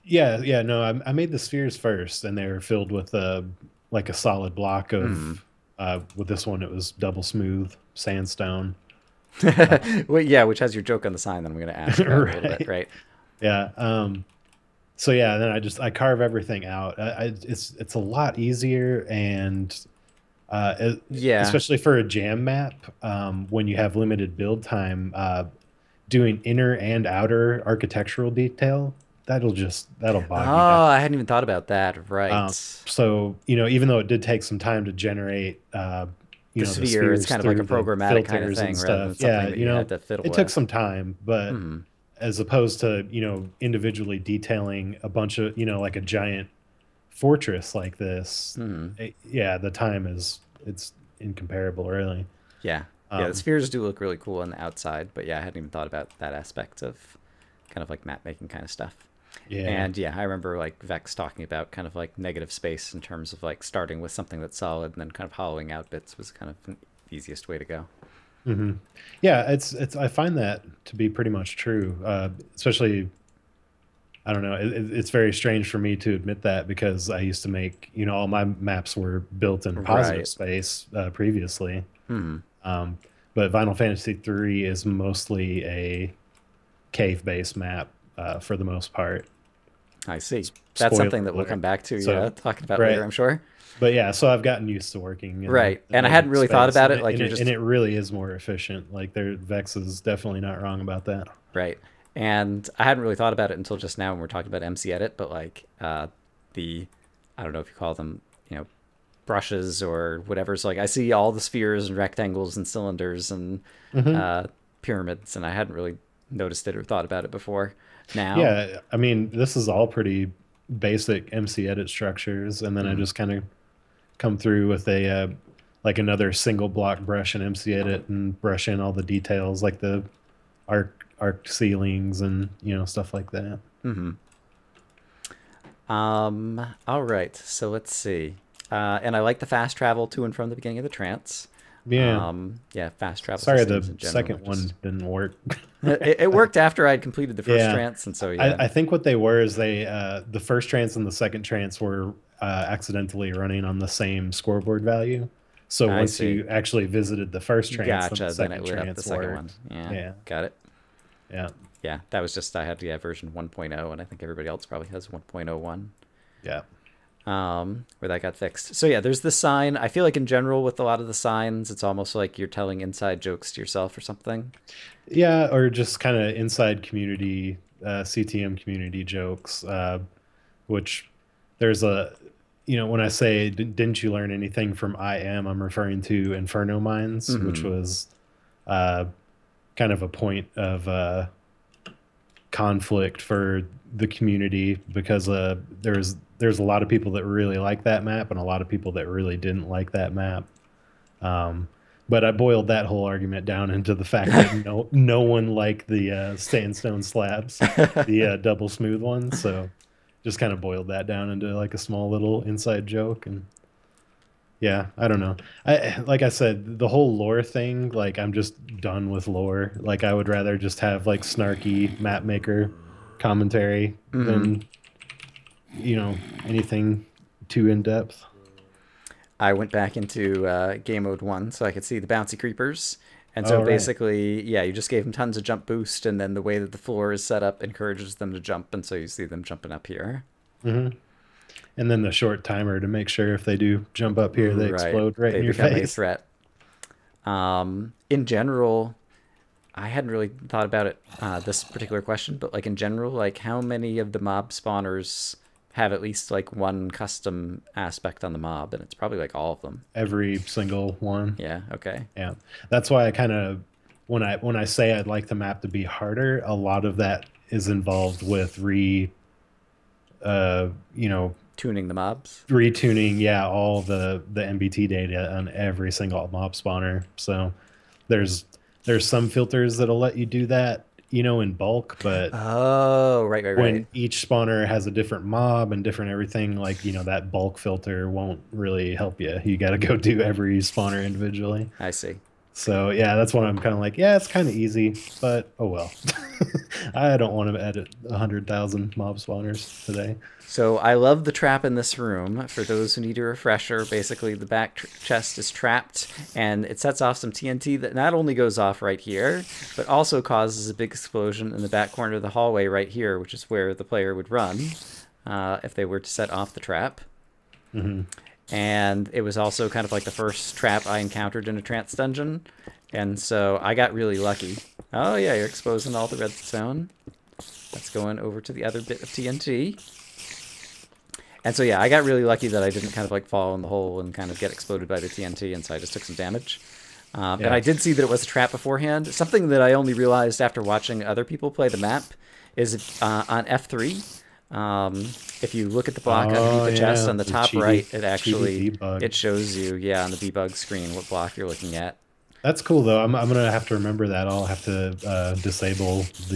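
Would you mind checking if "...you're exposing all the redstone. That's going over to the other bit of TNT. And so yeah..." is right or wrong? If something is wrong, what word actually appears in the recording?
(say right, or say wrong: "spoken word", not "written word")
right.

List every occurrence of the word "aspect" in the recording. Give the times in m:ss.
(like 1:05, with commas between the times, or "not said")
0:56, 4:17.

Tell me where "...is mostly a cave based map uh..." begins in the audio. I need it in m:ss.
1:24.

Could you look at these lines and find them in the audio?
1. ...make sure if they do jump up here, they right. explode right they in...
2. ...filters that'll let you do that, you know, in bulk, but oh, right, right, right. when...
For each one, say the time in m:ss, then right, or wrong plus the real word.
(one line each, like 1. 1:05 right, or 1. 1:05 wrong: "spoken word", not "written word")
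1. 4:02 right
2. 4:39 right.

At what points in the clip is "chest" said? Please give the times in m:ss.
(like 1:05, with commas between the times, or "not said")
5:05, 5:46.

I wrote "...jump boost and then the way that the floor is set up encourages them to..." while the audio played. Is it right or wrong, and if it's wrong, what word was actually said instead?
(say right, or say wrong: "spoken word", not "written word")
right.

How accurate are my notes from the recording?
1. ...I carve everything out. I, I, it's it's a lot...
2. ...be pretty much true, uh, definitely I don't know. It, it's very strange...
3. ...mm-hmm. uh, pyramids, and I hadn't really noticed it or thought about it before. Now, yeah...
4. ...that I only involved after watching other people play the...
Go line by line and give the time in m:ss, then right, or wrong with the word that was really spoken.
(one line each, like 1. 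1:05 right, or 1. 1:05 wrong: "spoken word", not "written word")
1. 0:15 right
2. 1:10 wrong: "especially", not "definitely"
3. 1:53 right
4. 5:39 wrong: "realized", not "involved".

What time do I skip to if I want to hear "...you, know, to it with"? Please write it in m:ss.
0:39.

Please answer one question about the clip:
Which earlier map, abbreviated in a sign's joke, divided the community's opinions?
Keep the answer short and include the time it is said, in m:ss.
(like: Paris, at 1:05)
Inferno Mines, at 3:06.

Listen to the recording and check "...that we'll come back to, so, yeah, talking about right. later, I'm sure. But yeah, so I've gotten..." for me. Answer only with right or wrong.
right.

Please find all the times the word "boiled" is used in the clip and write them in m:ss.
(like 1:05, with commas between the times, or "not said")
3:22, 3:30.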